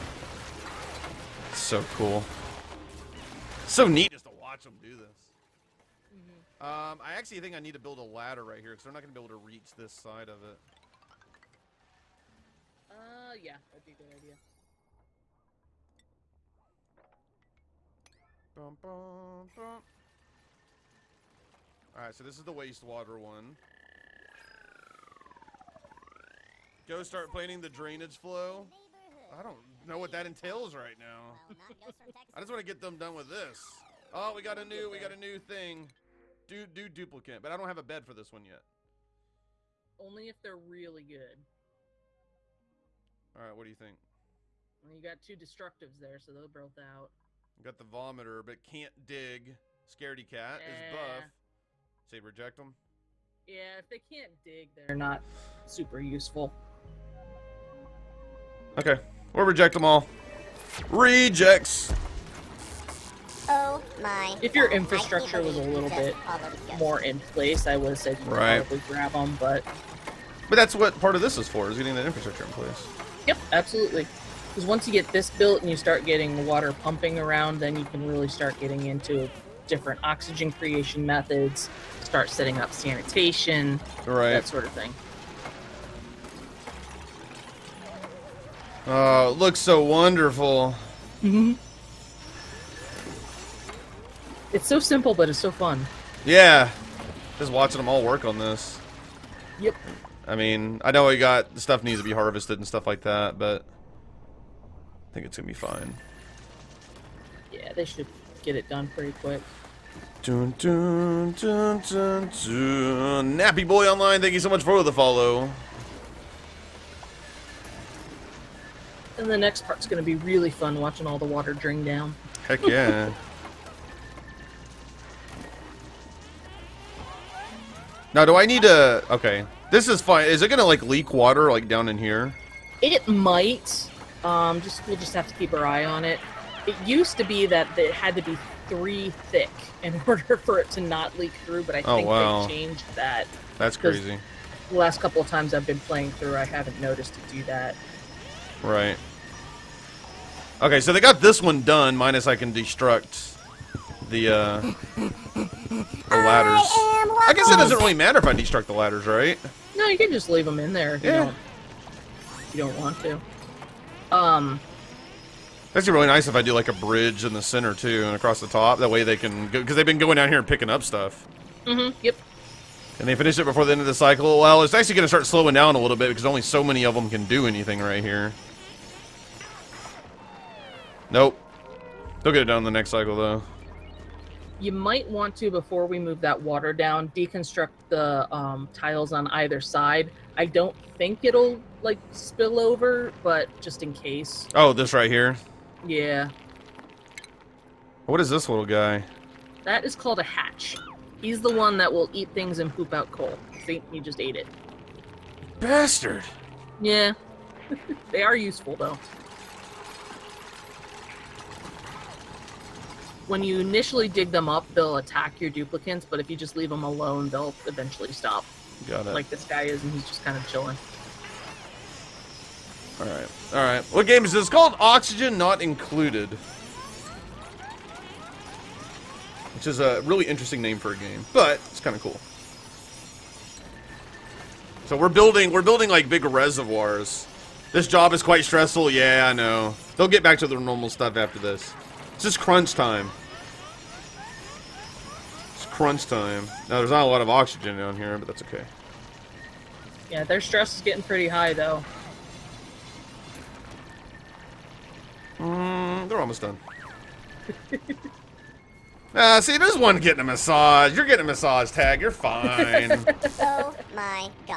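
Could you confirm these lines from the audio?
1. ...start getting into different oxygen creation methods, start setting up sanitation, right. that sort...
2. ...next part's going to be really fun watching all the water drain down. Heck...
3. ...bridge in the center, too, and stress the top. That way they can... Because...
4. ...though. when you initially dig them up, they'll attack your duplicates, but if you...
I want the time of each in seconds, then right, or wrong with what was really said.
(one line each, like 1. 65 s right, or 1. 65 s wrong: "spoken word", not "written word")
1. 78 s right
2. 119 s right
3. 166 s wrong: "across", not "stress"
4. 208 s right.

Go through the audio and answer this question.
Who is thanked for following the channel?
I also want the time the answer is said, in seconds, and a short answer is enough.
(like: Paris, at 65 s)
Nappy Boy Online, at 113 s.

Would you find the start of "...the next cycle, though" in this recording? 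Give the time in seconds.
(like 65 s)
182 s.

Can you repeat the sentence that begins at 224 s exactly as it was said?
It's called Oxygen Not Included, which is a really interesting name for a game, but it's kind of cool.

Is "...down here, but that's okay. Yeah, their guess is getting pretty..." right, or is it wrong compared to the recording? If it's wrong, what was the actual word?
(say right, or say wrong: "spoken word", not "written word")
wrong: "stress", not "guess".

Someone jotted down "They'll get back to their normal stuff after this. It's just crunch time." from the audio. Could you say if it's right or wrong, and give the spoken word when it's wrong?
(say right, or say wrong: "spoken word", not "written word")
right.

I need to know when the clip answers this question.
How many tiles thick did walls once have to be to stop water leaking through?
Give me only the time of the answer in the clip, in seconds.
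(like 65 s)
138 s.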